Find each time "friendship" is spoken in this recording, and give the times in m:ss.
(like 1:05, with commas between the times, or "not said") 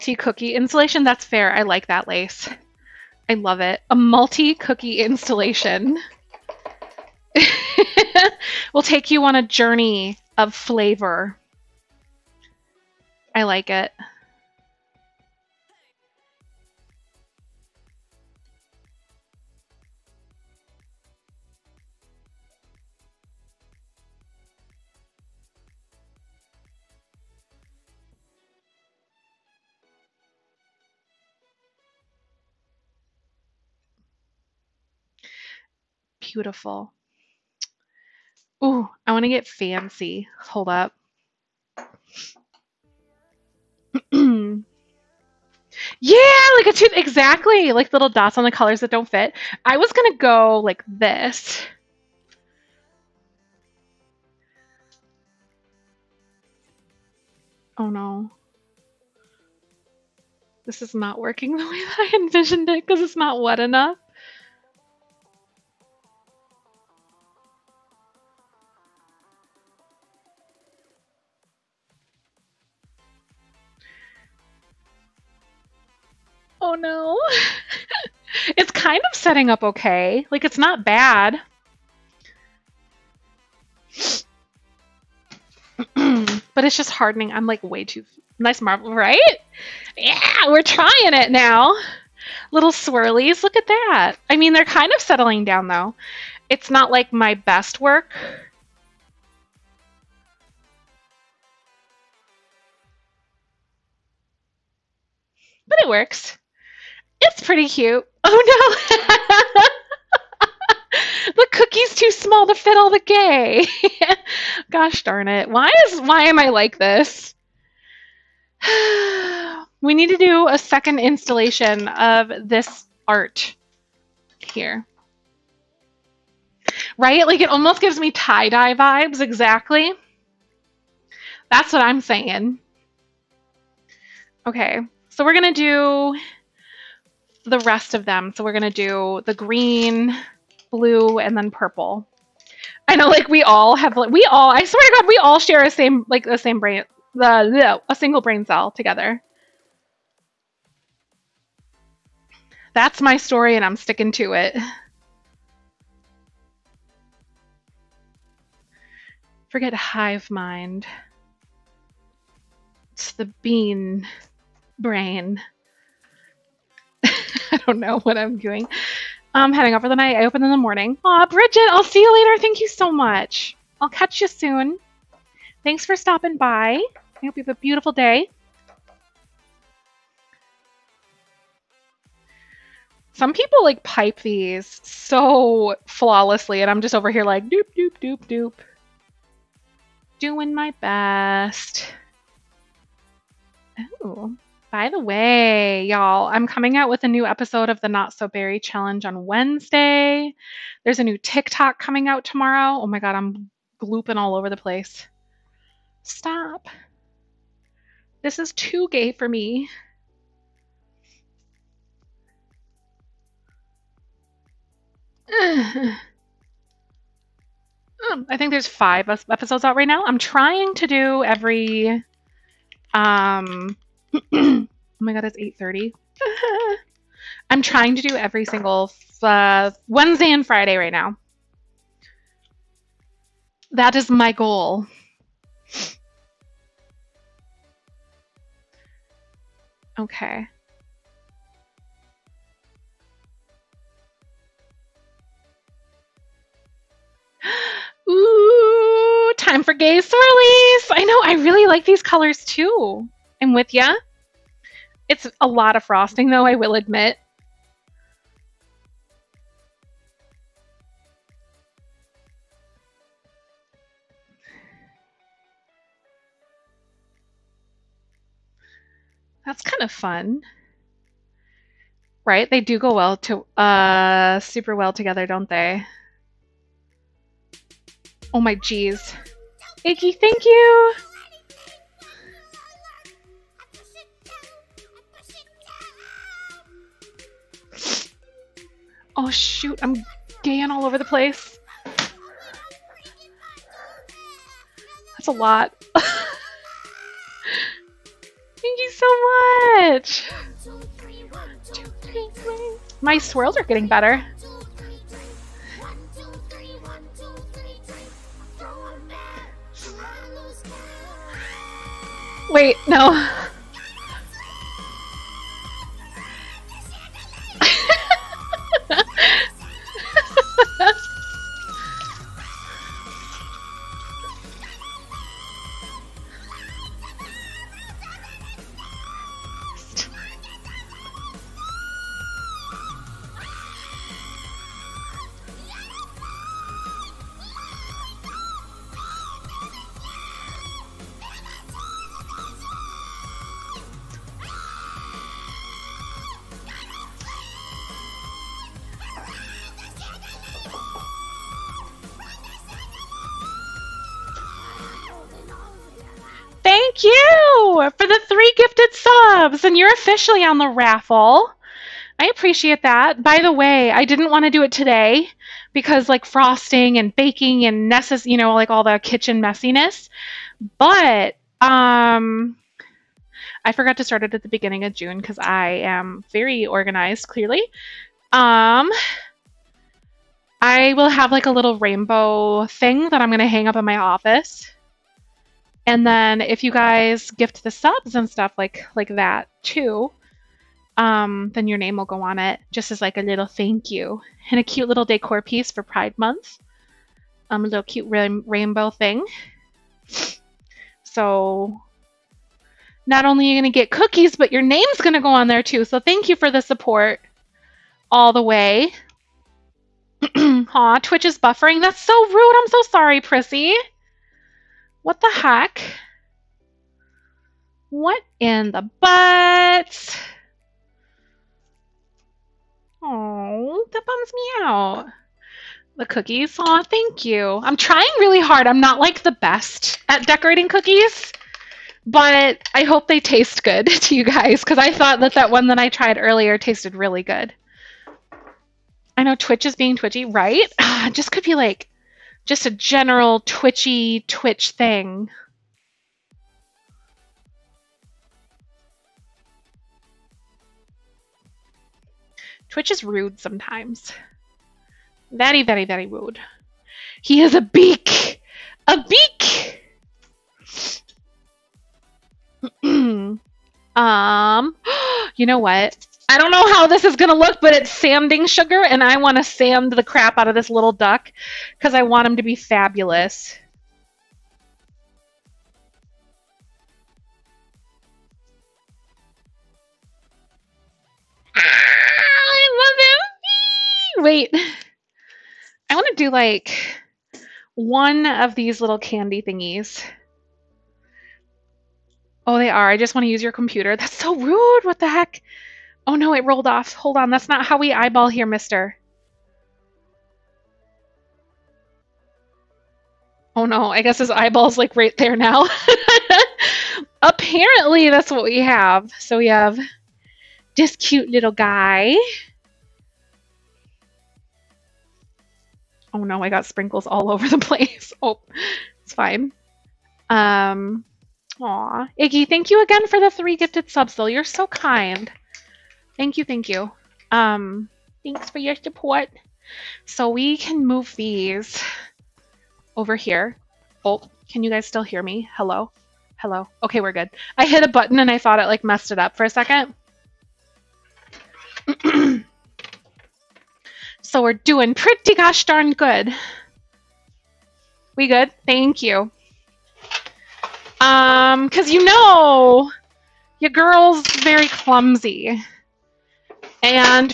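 not said.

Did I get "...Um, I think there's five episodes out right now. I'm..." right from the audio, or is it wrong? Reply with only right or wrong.
right.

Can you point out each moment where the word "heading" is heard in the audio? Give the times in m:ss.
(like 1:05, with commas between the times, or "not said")
2:49.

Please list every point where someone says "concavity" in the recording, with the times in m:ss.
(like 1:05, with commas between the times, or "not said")
not said.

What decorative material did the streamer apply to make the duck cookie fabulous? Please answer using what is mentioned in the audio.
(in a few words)
sanding sugar.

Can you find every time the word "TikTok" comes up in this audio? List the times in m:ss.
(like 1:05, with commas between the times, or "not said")
3:21.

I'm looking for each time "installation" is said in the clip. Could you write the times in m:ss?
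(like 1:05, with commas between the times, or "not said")
0:00, 0:04, 2:00.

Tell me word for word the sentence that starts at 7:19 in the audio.
I know Twitch is being twitchy, right?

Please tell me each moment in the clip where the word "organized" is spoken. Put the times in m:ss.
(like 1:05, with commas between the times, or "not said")
6:16.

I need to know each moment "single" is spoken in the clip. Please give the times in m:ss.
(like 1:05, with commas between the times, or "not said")
2:27, 3:48.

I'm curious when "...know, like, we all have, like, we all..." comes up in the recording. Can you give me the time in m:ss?
2:22.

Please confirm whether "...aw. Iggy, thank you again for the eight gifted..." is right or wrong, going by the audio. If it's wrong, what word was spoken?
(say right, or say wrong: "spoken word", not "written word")
wrong: "three", not "eight".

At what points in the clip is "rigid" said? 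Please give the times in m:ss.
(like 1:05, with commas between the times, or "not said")
not said.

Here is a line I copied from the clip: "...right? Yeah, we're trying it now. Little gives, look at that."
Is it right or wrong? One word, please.
wrong.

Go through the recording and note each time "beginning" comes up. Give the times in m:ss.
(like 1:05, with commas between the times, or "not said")
6:14.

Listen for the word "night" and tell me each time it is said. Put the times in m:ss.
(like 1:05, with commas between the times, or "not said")
2:49.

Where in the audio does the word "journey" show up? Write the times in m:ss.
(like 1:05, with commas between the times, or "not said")
0:09.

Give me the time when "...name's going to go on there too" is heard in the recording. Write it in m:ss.
6:44.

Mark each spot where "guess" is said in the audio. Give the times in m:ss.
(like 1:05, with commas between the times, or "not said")
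8:24.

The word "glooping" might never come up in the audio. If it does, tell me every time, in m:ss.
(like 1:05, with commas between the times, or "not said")
3:23.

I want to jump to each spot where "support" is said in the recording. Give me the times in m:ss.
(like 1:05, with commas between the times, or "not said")
6:46, 8:48.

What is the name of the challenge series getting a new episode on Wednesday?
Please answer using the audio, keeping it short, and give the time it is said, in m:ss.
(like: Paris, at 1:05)
Not So Berry Challenge, at 3:17.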